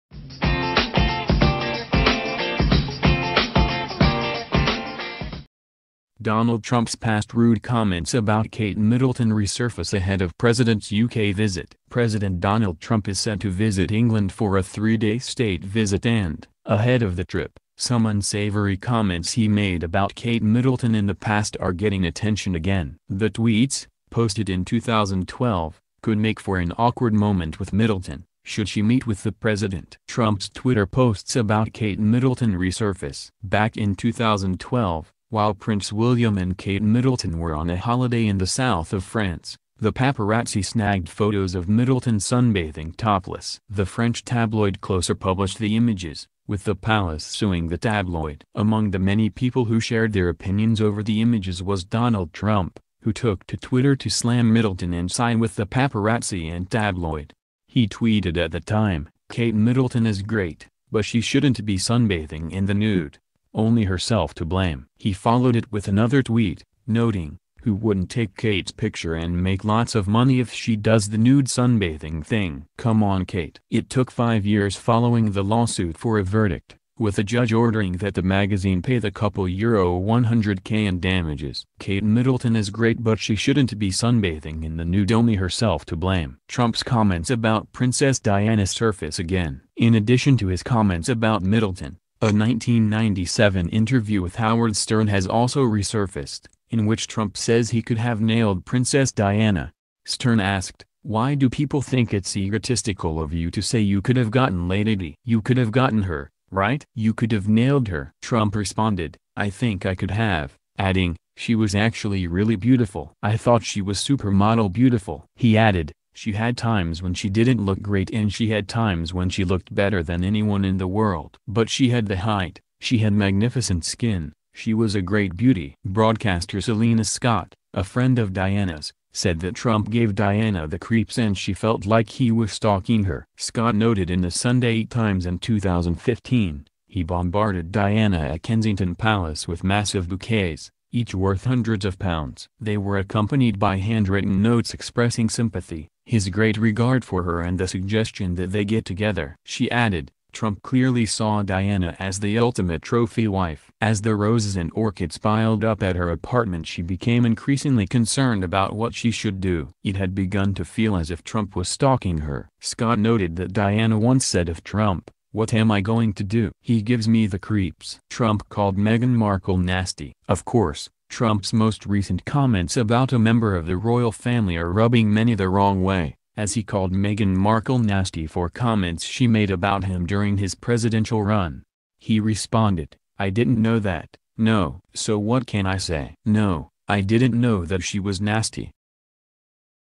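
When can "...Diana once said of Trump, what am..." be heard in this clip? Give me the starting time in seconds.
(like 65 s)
163 s.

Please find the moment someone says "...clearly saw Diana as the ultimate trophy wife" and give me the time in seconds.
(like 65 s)
150 s.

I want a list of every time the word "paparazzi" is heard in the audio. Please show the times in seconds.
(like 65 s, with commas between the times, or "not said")
39 s, 55 s.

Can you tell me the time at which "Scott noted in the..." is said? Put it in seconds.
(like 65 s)
133 s.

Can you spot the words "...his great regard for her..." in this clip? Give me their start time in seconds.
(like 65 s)
146 s.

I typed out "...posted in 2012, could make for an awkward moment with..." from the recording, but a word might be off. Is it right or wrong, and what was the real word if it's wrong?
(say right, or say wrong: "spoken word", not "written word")
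right.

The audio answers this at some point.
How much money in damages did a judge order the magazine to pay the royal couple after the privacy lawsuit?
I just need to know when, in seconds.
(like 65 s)
79 s.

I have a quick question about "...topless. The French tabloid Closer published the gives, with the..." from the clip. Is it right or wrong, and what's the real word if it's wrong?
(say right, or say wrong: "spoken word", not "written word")
wrong: "images", not "gives".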